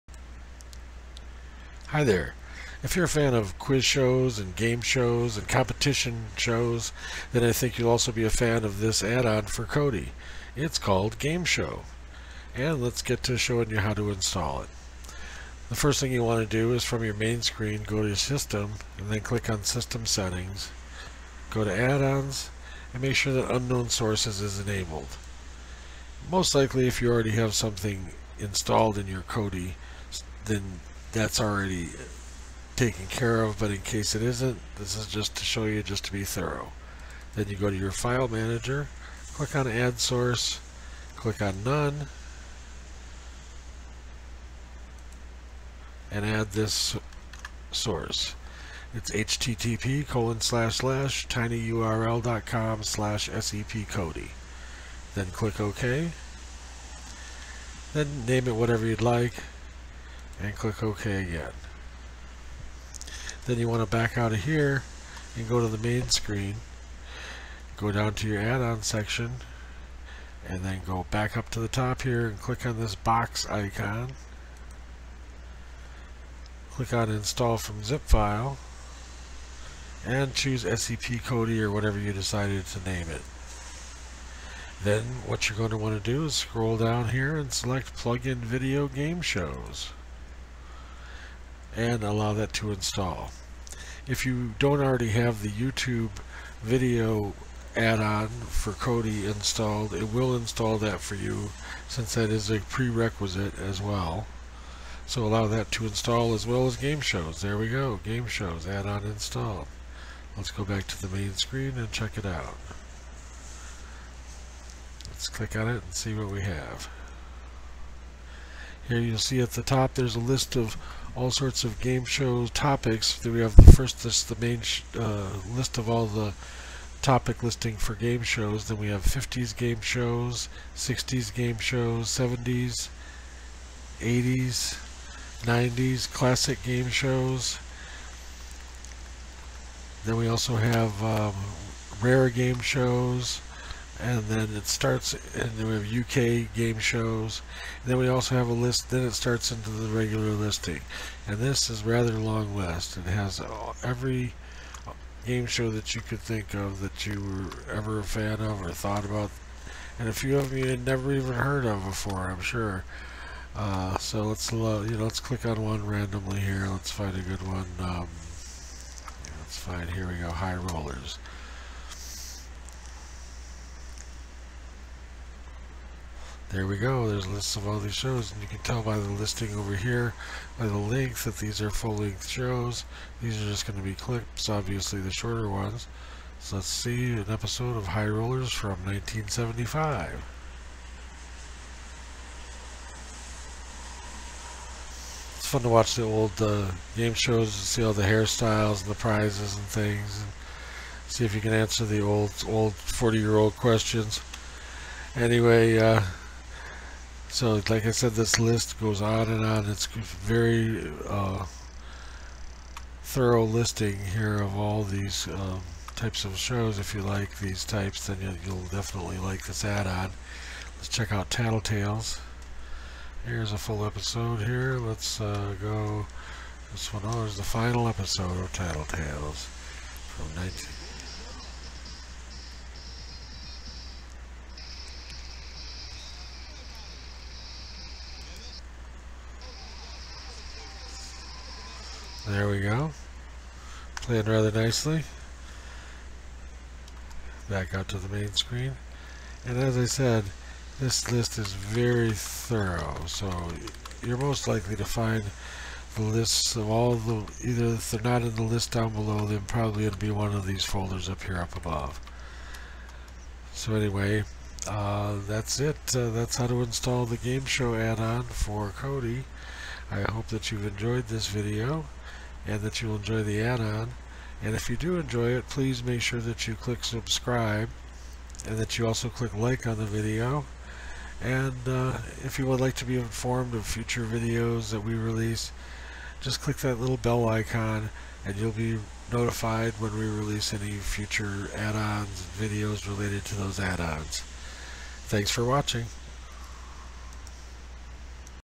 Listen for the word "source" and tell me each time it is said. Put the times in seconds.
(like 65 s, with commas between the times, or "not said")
23 s, 39 s, 47 s.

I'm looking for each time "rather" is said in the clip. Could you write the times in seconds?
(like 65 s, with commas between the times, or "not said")
151 s, 244 s.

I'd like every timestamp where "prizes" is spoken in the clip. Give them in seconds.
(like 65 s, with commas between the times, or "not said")
198 s.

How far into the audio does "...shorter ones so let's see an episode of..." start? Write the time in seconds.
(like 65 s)
185 s.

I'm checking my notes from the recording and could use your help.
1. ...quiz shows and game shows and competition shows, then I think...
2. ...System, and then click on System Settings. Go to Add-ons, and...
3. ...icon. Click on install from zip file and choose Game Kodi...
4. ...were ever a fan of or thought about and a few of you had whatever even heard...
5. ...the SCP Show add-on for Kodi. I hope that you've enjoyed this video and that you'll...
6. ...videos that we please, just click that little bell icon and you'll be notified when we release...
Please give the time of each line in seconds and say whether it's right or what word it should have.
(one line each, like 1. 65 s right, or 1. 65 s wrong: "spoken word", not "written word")
1. 3 s right
2. 18 s right
3. 73 s wrong: "SCP", not "Game"
4. 157 s wrong: "never", not "whatever"
5. 267 s wrong: "Game", not "SCP"
6. 284 s wrong: "release", not "please".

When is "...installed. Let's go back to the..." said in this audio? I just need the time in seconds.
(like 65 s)
109 s.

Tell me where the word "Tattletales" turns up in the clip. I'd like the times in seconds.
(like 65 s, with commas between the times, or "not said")
221 s, 228 s.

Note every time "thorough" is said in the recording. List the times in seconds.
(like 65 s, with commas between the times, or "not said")
36 s, 213 s, 252 s.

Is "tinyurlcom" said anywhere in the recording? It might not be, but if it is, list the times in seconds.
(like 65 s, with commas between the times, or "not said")
51 s.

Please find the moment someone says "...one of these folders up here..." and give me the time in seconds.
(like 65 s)
260 s.